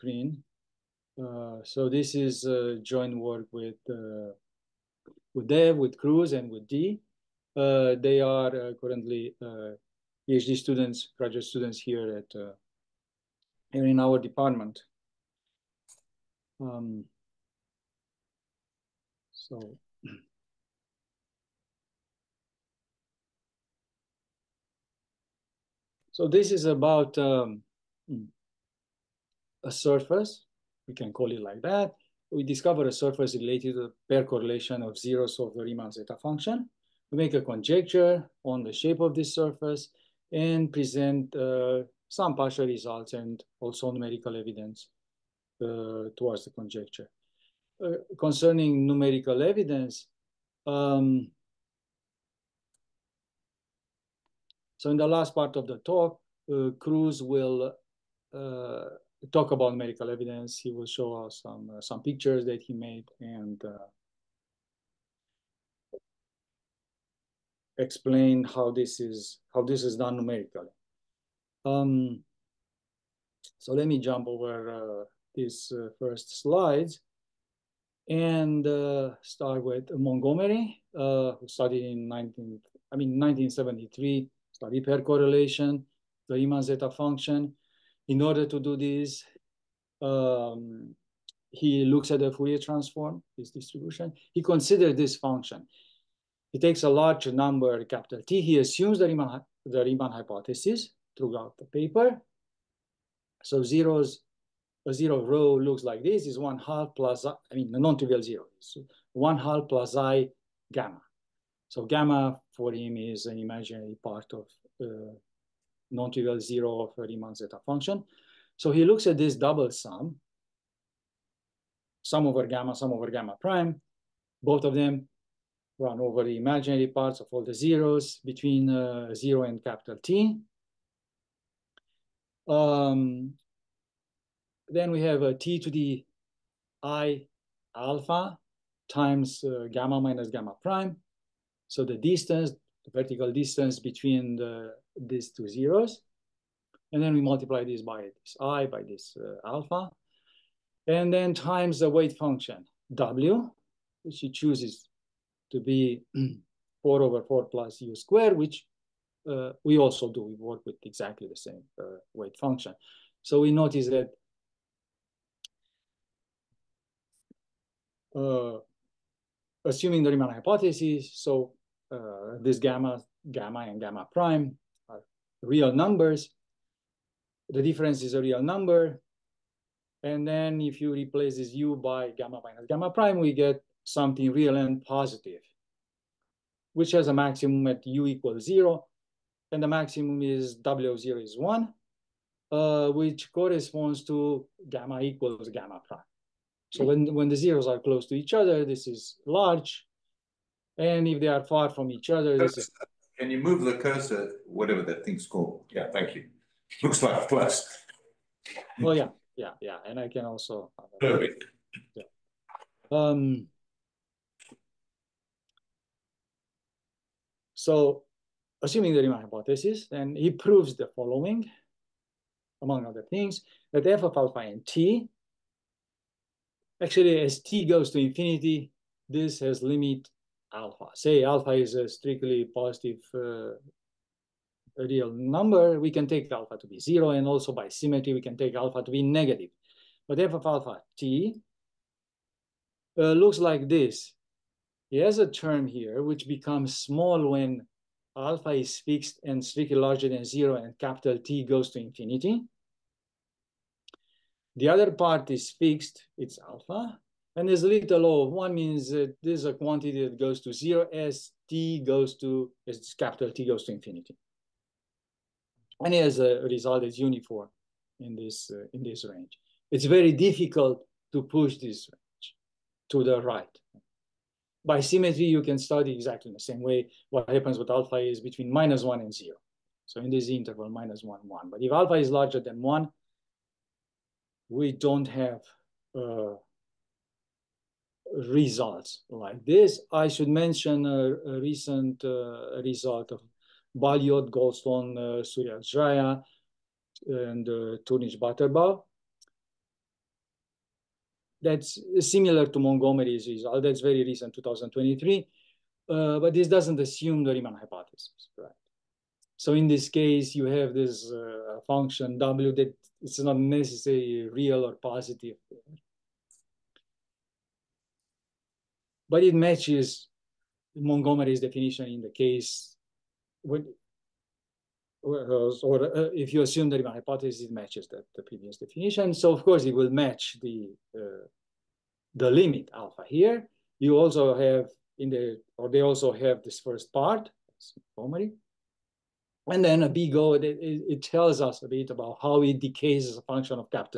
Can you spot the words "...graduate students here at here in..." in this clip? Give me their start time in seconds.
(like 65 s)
11 s.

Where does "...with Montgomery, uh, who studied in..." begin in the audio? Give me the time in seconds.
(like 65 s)
79 s.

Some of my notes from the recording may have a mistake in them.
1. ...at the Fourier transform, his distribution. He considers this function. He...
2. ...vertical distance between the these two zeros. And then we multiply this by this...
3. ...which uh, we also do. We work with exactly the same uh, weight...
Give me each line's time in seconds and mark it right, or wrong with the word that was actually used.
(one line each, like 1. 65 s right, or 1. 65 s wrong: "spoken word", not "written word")
1. 92 s right
2. 142 s right
3. 158 s right.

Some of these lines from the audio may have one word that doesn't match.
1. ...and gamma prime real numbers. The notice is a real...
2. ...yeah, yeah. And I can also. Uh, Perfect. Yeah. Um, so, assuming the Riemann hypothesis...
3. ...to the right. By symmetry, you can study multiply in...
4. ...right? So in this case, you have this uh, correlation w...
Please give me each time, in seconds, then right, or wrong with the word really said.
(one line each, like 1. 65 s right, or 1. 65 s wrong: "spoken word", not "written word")
1. 173 s wrong: "difference", not "notice"
2. 209 s right
3. 272 s wrong: "exactly", not "multiply"
4. 308 s wrong: "function", not "correlation".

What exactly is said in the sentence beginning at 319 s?
but it matches Montgomery's definition in the case when, or, uh, if you assume the my hypothesis, matches that the previous definition.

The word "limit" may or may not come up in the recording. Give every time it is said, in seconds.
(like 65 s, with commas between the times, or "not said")
229 s, 332 s.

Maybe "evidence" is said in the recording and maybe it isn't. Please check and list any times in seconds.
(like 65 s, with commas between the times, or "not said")
44 s, 49 s, 60 s.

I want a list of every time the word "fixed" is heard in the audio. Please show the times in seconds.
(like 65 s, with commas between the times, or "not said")
248 s, 255 s.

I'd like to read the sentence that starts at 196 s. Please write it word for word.
So when, when the zeros are close to each other, this is large.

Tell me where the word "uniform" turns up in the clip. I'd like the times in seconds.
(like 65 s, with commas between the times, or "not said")
266 s.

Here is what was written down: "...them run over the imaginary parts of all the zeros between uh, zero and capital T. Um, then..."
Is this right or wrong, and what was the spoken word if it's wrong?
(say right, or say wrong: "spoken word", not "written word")
right.